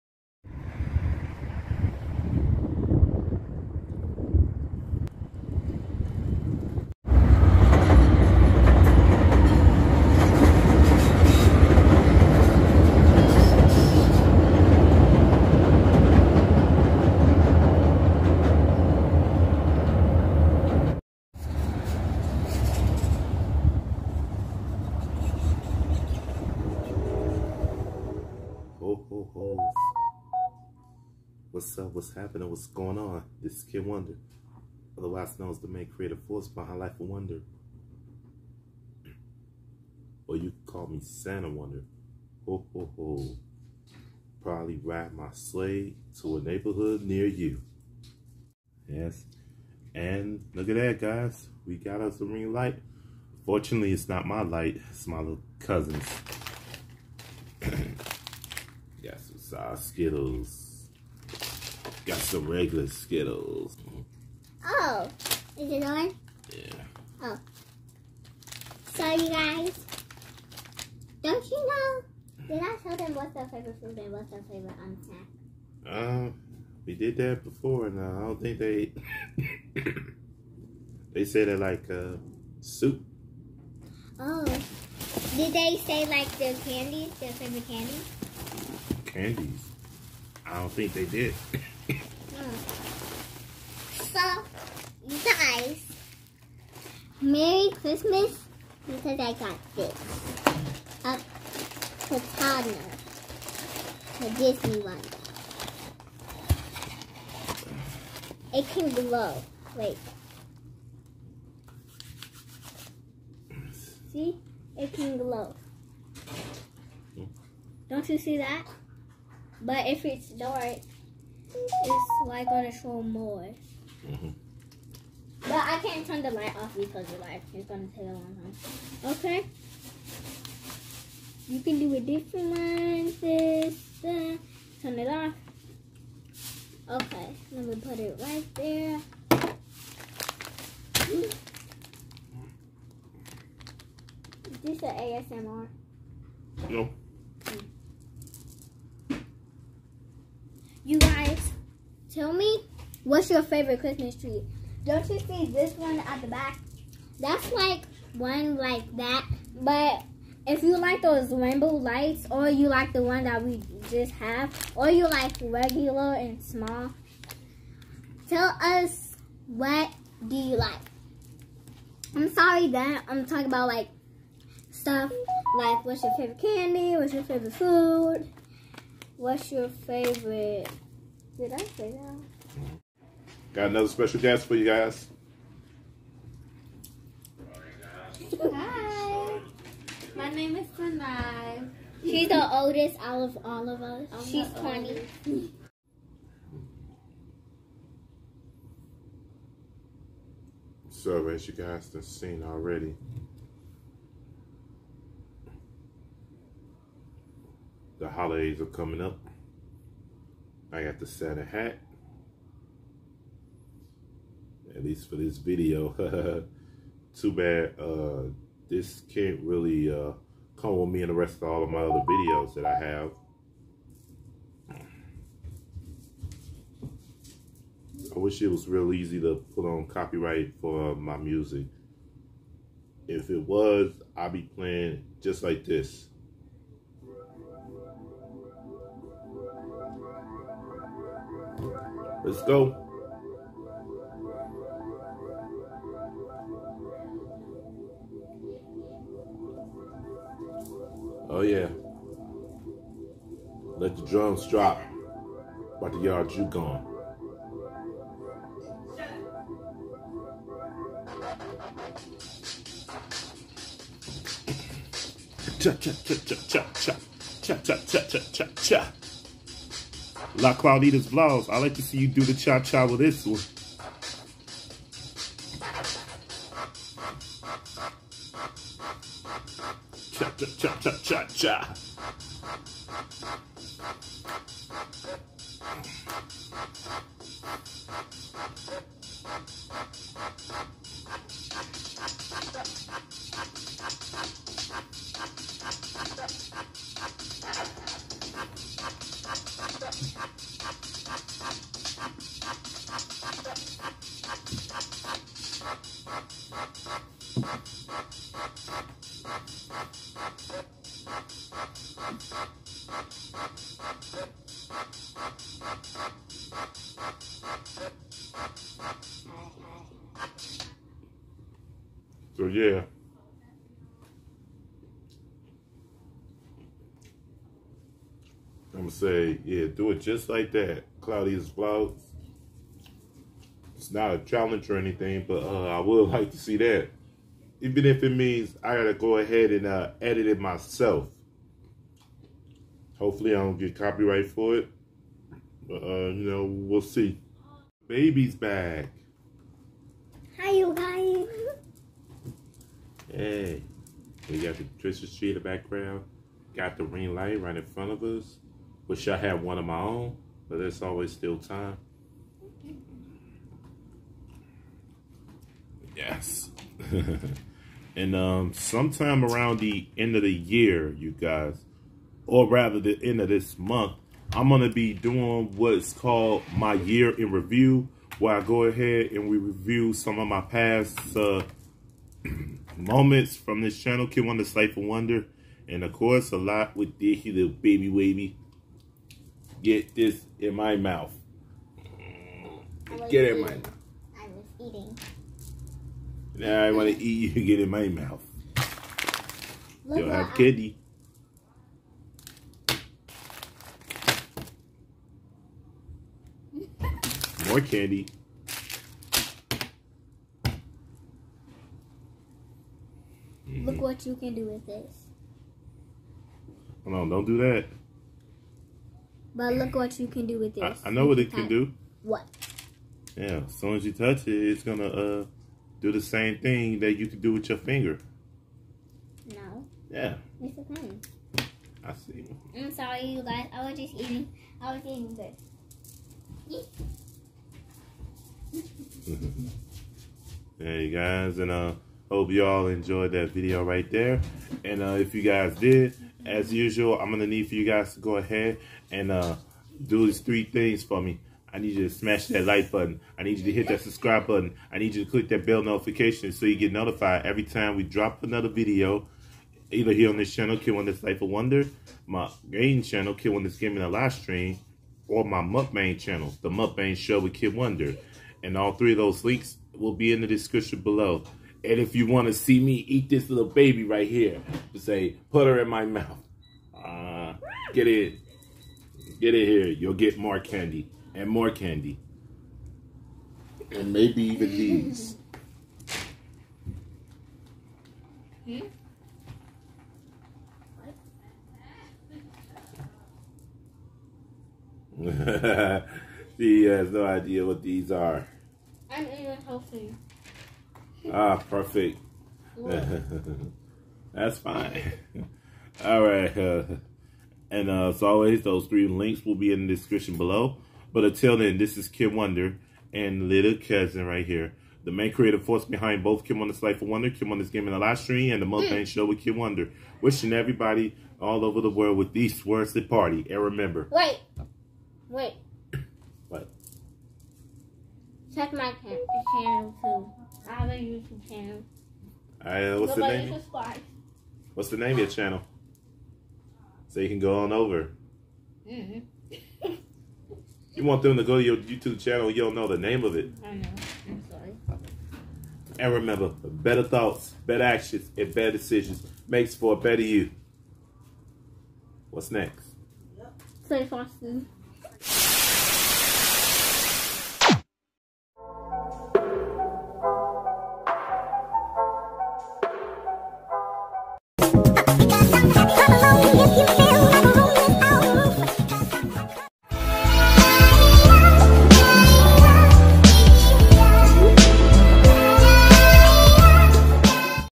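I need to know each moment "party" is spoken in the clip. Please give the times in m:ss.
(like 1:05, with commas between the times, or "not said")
8:42.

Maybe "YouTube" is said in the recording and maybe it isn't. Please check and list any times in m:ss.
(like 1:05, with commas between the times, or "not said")
8:50, 9:01.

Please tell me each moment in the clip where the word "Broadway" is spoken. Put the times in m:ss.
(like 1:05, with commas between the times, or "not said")
not said.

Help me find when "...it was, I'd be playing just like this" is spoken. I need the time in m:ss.
3:53.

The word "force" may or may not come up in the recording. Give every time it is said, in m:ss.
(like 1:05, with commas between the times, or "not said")
0:36, 8:35.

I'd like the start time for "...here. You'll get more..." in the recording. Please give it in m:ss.
7:59.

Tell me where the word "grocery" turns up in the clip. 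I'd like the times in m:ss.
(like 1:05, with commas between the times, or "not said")
not said.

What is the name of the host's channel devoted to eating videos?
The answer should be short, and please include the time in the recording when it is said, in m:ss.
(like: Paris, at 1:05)
The Mukbang Show with Kid Wonder, at 7:46.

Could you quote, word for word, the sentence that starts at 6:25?
And of course, a lot with Dicky the Baby Wavy.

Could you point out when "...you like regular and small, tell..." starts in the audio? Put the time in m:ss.
2:44.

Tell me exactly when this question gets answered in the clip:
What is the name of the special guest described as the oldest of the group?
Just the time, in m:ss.
3:10.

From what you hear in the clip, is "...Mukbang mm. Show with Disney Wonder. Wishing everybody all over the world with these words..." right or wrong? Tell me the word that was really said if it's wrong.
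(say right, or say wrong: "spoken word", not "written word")
wrong: "Kid", not "Disney".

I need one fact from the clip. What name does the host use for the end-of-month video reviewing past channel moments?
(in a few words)
Year in review.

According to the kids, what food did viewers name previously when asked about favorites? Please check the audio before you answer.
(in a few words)
Soup.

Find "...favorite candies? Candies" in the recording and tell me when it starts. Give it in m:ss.
1:27.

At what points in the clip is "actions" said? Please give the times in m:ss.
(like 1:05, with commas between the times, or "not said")
9:07.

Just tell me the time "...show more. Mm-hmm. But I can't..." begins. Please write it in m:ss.
2:02.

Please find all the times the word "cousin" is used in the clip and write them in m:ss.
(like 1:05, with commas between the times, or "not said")
0:55, 8:33.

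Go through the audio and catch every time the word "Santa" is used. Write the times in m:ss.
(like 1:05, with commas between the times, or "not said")
0:41, 3:31.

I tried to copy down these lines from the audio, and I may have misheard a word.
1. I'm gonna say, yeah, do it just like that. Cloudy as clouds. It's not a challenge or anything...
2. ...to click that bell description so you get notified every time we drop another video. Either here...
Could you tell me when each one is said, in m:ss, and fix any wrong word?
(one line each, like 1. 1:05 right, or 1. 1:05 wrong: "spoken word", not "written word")
1. 5:28 right
2. 7:35 wrong: "notification", not "description".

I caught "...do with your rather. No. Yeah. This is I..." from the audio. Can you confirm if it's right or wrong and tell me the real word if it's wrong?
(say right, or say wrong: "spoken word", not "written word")
wrong: "finger", not "rather".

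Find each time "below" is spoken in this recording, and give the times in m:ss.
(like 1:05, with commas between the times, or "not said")
7:50, 8:30.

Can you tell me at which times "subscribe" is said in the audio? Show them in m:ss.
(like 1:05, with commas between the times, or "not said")
7:33, 8:53.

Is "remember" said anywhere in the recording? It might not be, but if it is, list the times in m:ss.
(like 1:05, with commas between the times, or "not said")
8:43, 9:05.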